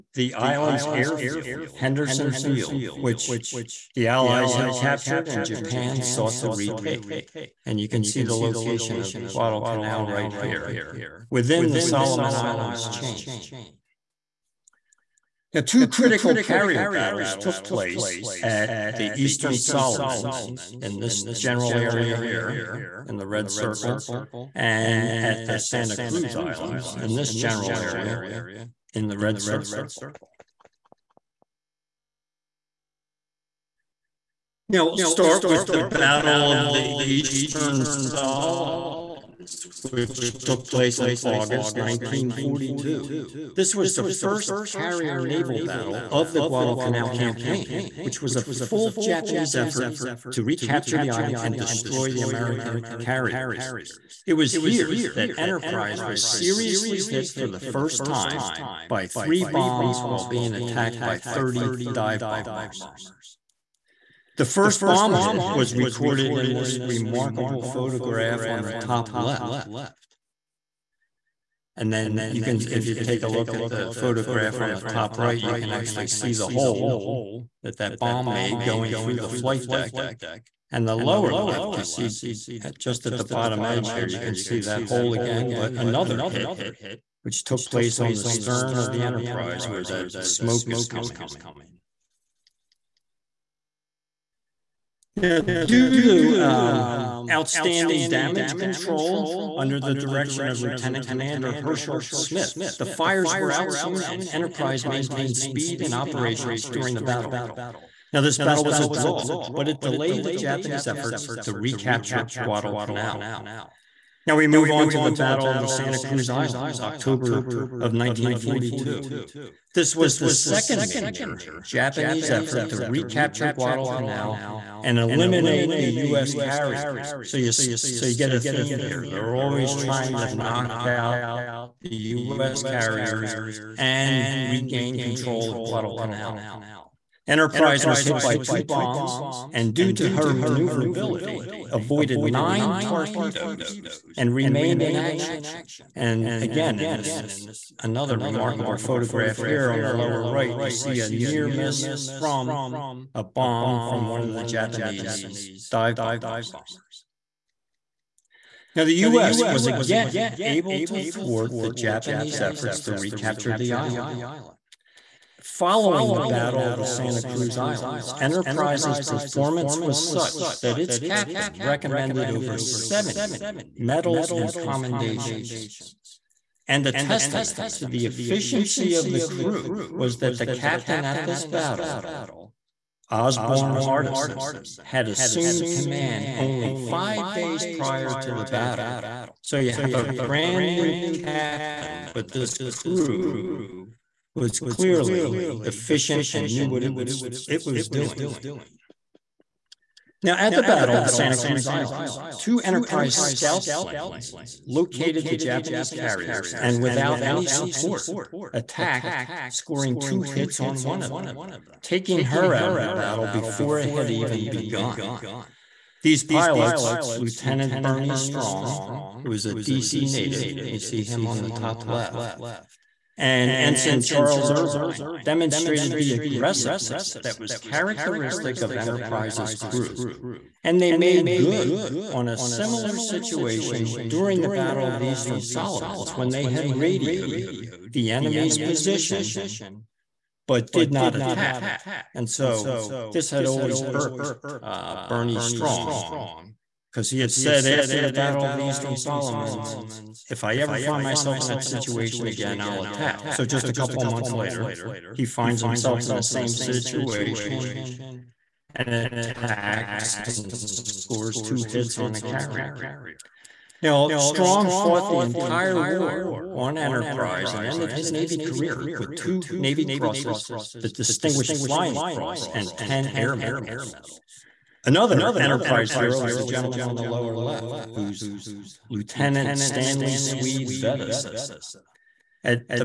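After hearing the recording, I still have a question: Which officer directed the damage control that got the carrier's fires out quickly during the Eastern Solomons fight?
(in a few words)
Herschel Smith.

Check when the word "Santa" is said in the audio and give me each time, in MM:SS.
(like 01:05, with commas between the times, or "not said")
00:25, 01:55, 02:46, 03:21.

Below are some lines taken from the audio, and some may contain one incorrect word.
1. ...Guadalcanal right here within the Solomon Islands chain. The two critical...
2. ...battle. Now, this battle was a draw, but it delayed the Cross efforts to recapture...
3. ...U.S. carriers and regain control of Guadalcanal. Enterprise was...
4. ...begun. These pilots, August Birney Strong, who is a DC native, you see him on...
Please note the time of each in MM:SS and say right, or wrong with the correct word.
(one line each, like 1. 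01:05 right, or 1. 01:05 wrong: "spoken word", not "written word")
1. 00:09 right
2. 01:47 wrong: "Japanese", not "Cross"
3. 02:11 right
4. 03:34 wrong: "Lieutenant", not "August".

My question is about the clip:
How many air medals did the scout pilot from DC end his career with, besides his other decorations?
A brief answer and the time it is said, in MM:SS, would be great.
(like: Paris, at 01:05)
10, at 04:32.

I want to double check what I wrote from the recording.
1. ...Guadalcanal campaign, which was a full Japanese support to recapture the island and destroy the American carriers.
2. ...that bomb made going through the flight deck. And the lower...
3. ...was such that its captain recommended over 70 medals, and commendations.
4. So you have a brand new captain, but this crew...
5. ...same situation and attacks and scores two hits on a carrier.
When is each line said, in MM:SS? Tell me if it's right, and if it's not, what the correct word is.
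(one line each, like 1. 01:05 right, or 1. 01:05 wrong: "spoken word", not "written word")
1. 00:46 wrong: "effort", not "support"
2. 01:17 right
3. 02:49 right
4. 03:09 right
5. 04:16 right.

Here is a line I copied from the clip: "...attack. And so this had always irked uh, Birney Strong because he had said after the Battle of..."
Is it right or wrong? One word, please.
right.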